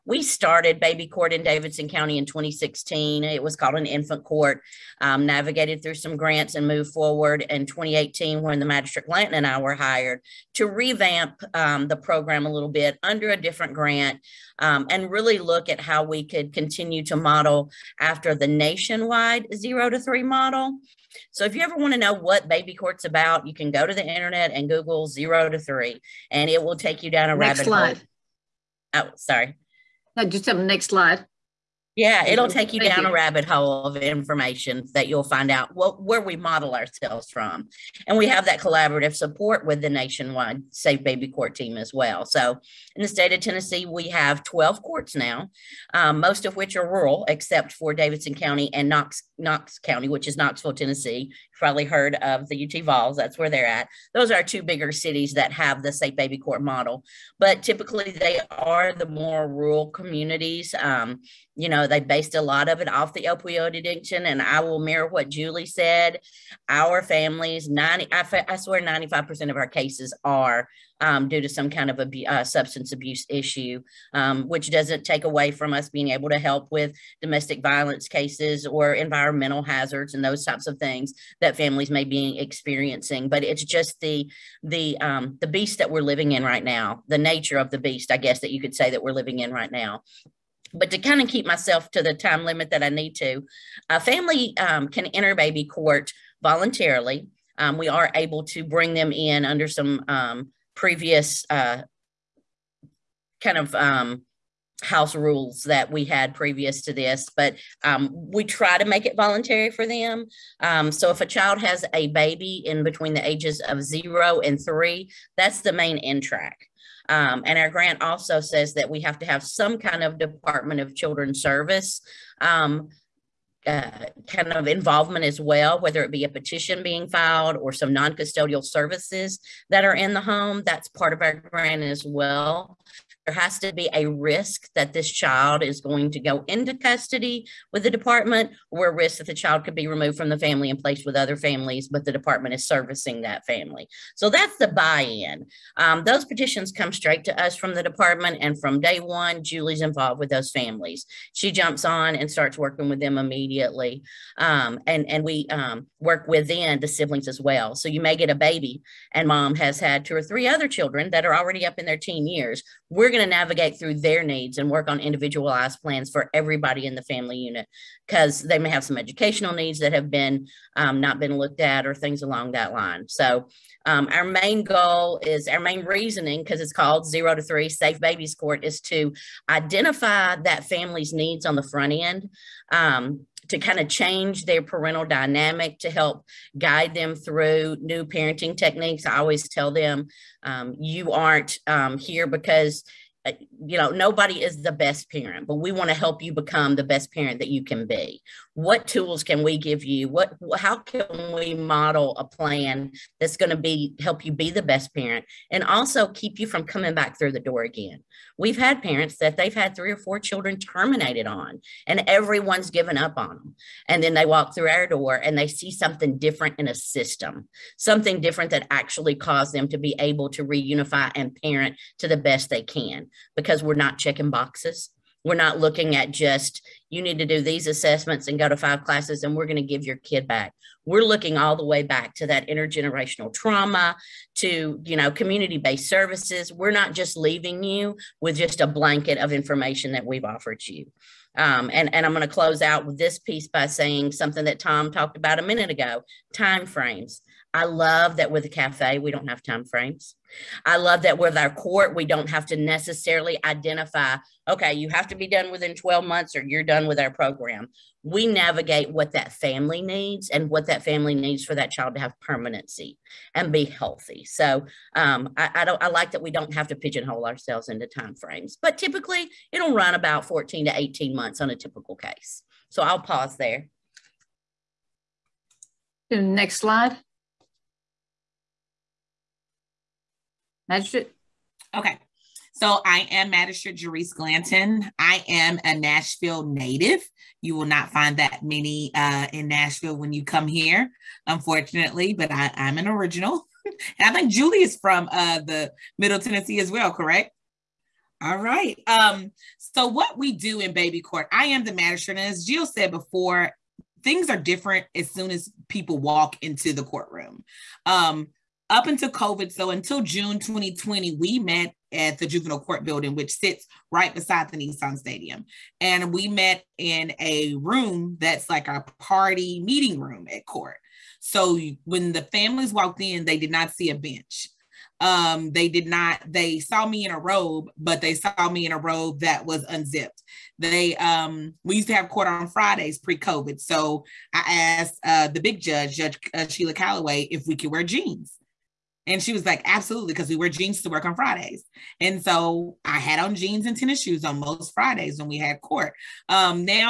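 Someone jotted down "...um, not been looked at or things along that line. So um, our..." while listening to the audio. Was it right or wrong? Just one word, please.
right.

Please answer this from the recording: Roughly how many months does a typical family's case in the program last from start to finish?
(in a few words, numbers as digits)
14 to 18 months.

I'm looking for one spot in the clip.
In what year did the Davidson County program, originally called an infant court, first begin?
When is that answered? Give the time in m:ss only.
0:02.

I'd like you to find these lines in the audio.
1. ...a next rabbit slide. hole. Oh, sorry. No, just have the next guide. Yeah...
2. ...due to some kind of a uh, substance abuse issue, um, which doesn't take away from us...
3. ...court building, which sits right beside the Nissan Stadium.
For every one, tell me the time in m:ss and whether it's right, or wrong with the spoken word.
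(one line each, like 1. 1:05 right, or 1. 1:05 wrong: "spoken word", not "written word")
1. 0:27 wrong: "slide", not "guide"
2. 1:11 right
3. 5:12 right.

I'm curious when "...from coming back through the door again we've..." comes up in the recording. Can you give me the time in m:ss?
3:26.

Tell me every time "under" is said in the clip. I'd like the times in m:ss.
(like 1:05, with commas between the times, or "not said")
0:13, 1:39.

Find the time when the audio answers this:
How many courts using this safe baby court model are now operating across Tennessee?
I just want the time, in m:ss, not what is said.
0:44.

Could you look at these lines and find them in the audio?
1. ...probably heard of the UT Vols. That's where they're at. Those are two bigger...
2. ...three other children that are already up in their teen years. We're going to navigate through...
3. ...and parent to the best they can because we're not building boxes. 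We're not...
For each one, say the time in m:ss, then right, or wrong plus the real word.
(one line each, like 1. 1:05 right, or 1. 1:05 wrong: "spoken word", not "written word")
1. 0:51 right
2. 2:40 right
3. 3:41 wrong: "checking", not "building".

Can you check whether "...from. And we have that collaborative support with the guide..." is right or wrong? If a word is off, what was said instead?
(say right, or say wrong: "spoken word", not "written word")
wrong: "nationwide", not "guide".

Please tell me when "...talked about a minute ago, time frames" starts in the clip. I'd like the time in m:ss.
4:04.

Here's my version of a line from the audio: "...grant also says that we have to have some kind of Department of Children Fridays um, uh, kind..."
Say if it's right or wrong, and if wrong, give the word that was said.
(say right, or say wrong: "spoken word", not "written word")
wrong: "Service", not "Fridays".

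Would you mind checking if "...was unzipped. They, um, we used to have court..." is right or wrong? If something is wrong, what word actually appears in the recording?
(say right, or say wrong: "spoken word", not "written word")
right.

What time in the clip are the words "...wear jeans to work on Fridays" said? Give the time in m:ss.
5:40.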